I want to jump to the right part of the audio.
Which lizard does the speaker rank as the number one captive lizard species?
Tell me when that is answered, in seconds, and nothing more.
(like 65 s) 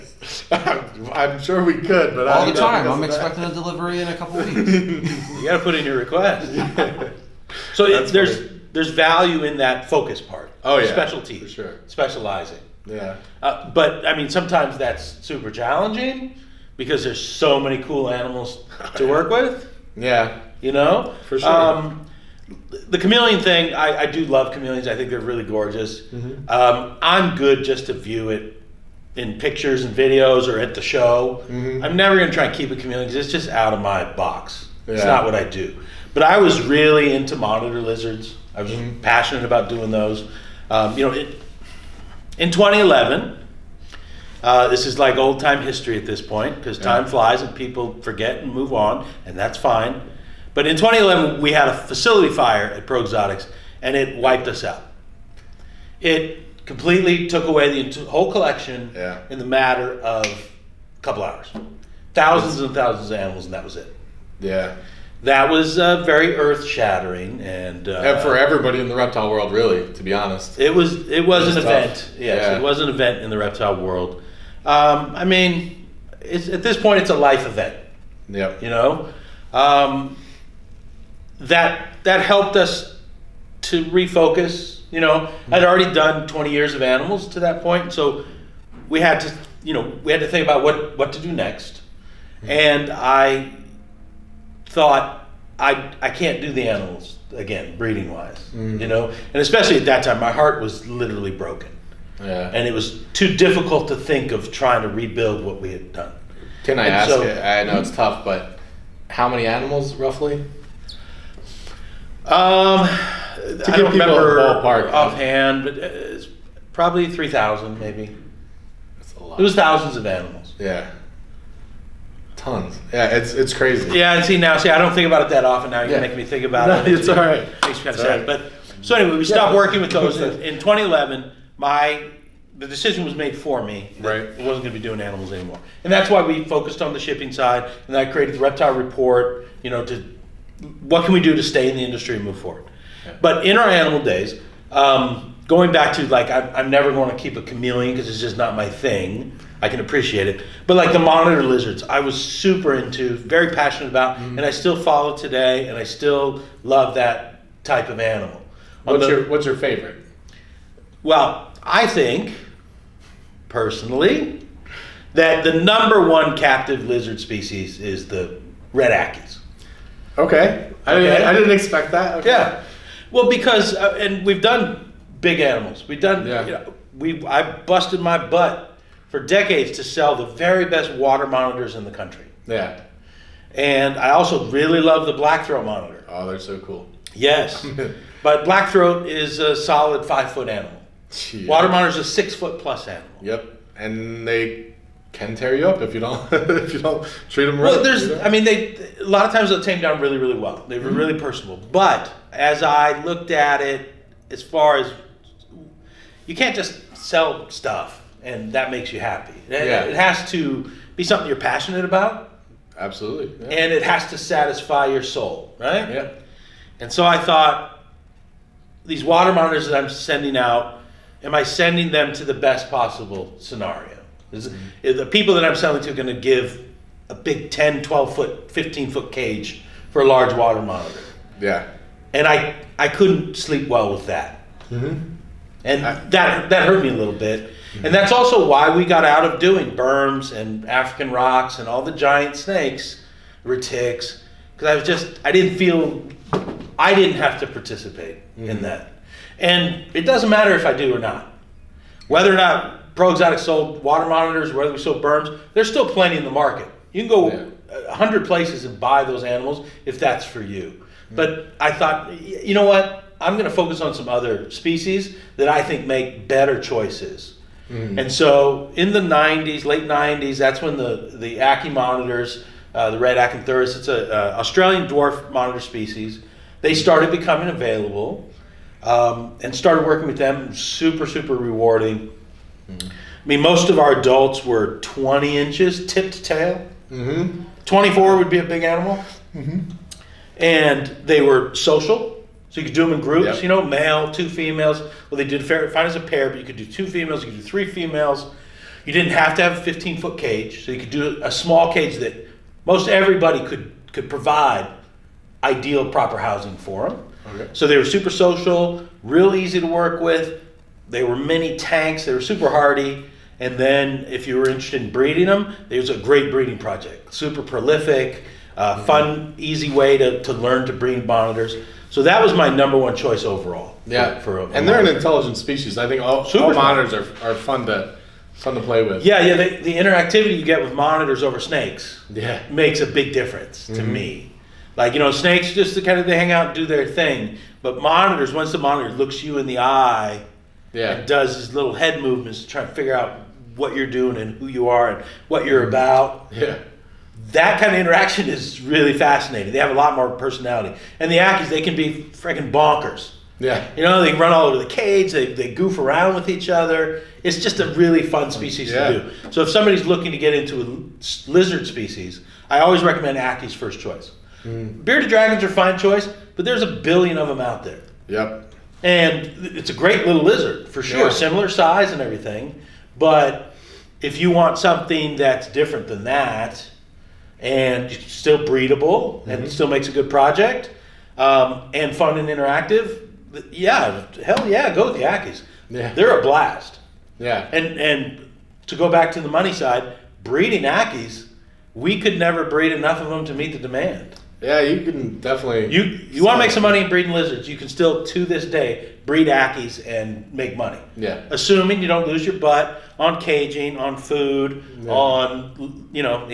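168 s.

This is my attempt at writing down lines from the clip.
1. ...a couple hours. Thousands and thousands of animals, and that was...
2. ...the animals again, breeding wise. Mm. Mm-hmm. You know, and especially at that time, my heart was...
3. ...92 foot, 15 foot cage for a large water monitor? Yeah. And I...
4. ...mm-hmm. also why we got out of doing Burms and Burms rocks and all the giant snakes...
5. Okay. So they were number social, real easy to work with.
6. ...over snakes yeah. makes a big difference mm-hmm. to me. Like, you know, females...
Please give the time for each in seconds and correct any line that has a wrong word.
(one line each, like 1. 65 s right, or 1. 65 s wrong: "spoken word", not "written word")
1. 60 s right
2. 96 s right
3. 227 s wrong: "12", not "92"
4. 238 s wrong: "African", not "Burms"
5. 307 s wrong: "super", not "number"
6. 331 s wrong: "snakes", not "females".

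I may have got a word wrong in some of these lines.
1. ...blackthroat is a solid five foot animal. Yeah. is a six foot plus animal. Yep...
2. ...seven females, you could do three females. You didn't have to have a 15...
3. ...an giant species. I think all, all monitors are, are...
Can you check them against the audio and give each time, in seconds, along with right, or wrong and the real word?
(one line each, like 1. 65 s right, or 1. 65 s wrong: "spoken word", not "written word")
1. 188 s right
2. 296 s wrong: "two", not "seven"
3. 324 s wrong: "intelligent", not "giant".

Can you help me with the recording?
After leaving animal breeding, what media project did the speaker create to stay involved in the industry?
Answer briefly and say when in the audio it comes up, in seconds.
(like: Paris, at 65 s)
The Reptile Report, at 138 s.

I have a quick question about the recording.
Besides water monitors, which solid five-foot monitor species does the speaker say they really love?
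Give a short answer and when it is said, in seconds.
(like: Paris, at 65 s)
Blackthroat monitor, at 185 s.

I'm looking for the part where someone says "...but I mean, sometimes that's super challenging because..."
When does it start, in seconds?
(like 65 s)
13 s.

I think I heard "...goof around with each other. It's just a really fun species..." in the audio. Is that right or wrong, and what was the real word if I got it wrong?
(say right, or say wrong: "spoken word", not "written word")
right.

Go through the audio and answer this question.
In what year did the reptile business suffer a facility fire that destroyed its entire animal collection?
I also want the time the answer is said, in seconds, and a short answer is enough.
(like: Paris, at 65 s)
2011, at 42 s.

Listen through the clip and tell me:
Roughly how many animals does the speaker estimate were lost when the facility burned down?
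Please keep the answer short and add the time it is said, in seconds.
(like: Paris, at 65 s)
3000, at 117 s.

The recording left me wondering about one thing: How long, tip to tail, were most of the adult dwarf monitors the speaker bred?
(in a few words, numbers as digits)
20 inches.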